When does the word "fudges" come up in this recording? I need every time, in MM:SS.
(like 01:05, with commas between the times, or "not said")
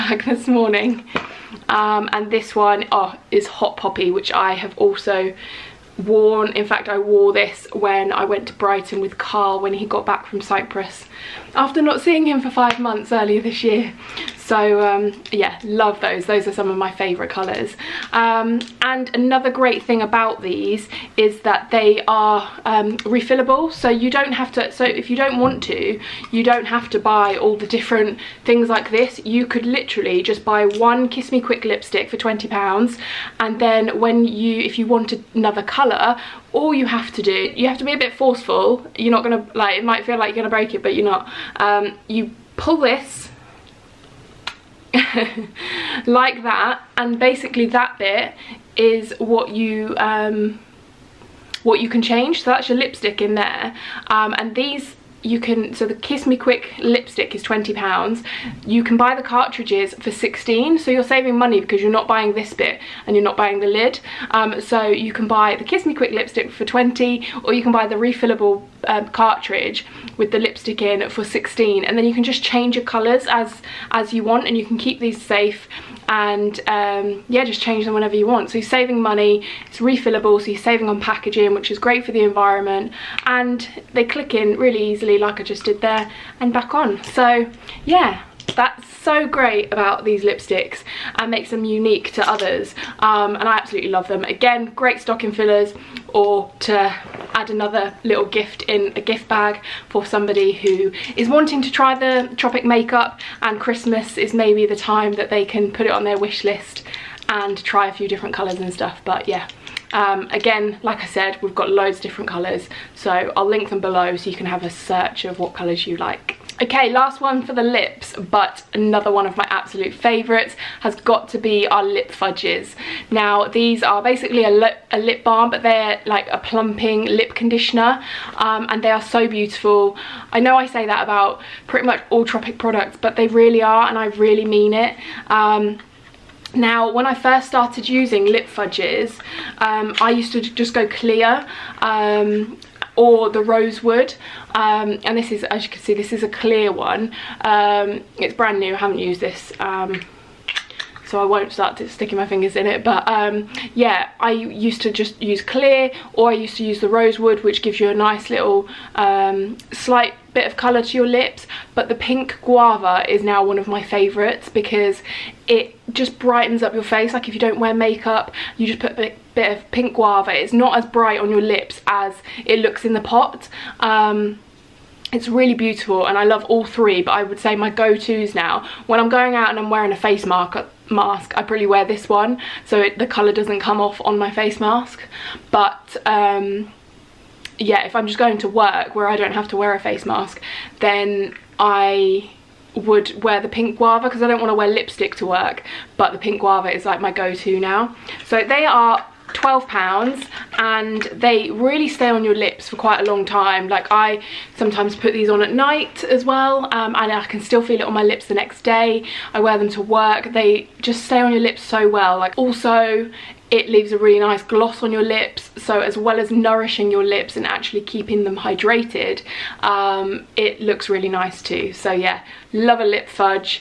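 02:02, 02:18, 03:43.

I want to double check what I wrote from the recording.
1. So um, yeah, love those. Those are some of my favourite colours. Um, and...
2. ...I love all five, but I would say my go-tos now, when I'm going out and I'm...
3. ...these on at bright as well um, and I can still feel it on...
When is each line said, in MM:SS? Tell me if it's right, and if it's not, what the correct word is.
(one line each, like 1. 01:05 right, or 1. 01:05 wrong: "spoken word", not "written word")
1. 00:14 right
2. 02:56 wrong: "three", not "five"
3. 03:25 wrong: "night", not "bright".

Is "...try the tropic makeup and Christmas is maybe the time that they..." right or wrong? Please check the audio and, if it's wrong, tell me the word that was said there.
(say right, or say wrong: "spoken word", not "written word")
right.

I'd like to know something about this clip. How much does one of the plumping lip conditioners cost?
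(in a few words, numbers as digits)
£12.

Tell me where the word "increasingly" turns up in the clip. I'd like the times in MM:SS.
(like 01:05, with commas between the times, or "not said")
not said.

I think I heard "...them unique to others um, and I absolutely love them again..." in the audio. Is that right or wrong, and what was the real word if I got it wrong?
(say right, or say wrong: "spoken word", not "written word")
right.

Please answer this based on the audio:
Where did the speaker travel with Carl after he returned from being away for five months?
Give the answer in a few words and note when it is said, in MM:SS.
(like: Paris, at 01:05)
Brighton, at 00:08.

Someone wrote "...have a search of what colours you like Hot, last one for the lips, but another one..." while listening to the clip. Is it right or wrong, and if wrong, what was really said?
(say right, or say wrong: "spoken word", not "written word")
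wrong: "Okay", not "Hot".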